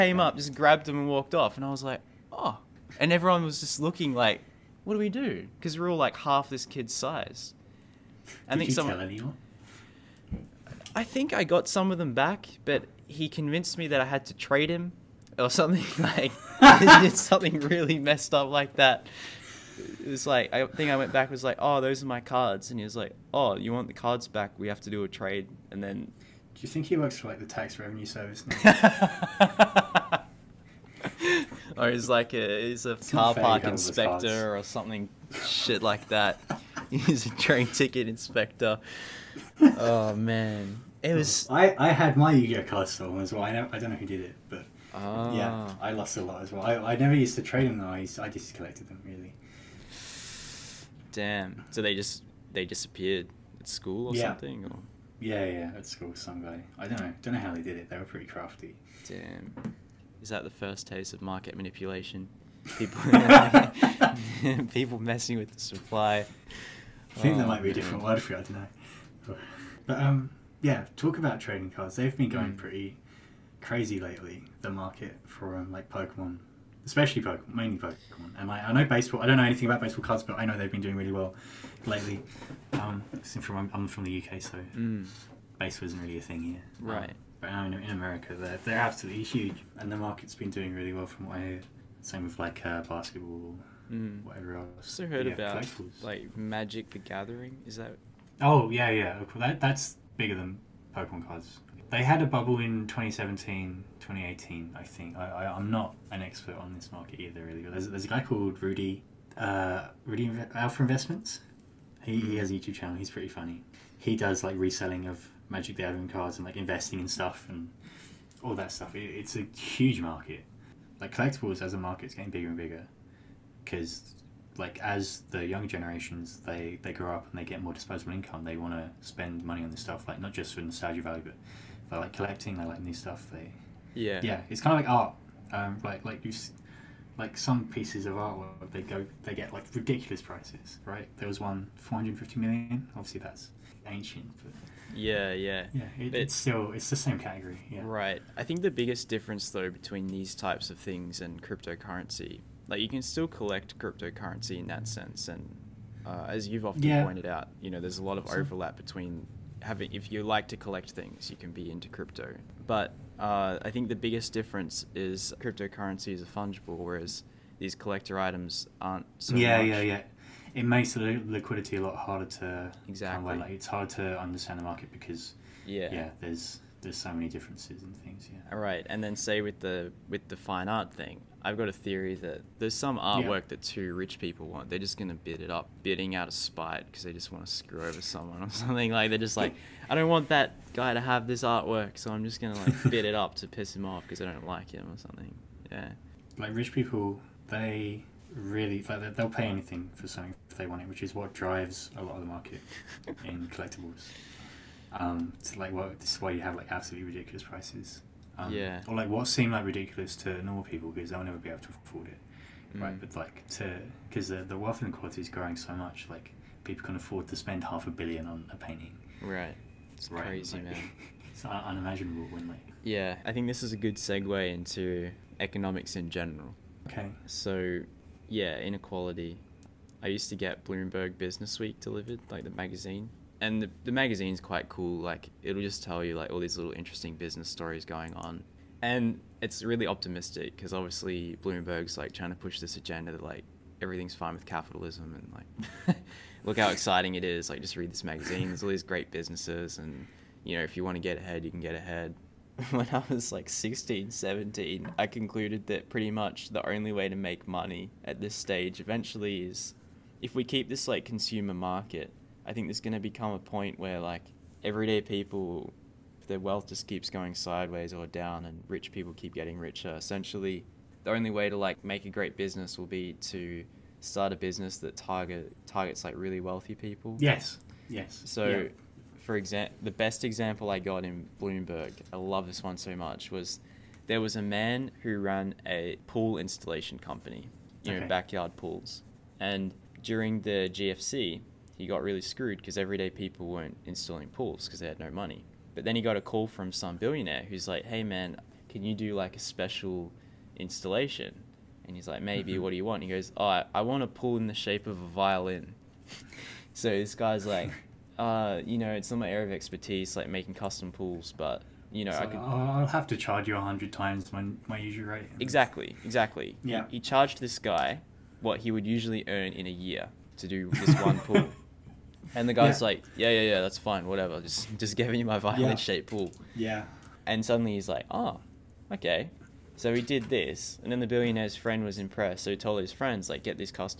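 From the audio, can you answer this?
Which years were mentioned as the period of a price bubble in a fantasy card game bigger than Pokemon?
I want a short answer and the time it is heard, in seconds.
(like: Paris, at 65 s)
2017, 2018, at 102 s.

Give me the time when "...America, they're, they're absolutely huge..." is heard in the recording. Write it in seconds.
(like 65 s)
87 s.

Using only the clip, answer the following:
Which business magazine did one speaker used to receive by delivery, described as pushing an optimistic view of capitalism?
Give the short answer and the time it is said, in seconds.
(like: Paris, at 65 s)
Bloomberg Business Week, at 230 s.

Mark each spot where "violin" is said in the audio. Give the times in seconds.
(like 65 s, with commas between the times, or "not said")
305 s, 325 s.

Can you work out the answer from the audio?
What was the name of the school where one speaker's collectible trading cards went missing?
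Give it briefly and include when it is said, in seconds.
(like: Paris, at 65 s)
Sun Valley, at 56 s.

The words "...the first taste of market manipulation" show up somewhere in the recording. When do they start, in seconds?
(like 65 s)
60 s.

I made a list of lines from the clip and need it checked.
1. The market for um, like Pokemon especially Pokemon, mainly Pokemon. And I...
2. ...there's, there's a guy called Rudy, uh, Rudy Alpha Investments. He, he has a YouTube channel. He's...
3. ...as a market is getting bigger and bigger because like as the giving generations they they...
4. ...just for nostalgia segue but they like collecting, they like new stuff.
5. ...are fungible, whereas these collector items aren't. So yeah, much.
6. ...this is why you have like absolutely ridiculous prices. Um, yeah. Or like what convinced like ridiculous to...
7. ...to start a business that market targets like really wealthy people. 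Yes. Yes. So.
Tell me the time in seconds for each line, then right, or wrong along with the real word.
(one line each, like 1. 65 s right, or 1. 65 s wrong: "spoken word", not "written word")
1. 74 s right
2. 107 s right
3. 121 s wrong: "young", not "giving"
4. 130 s wrong: "value", not "segue"
5. 166 s right
6. 205 s wrong: "seemed", not "convinced"
7. 273 s wrong: "target", not "market".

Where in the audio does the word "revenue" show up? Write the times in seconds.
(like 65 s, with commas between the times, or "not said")
27 s.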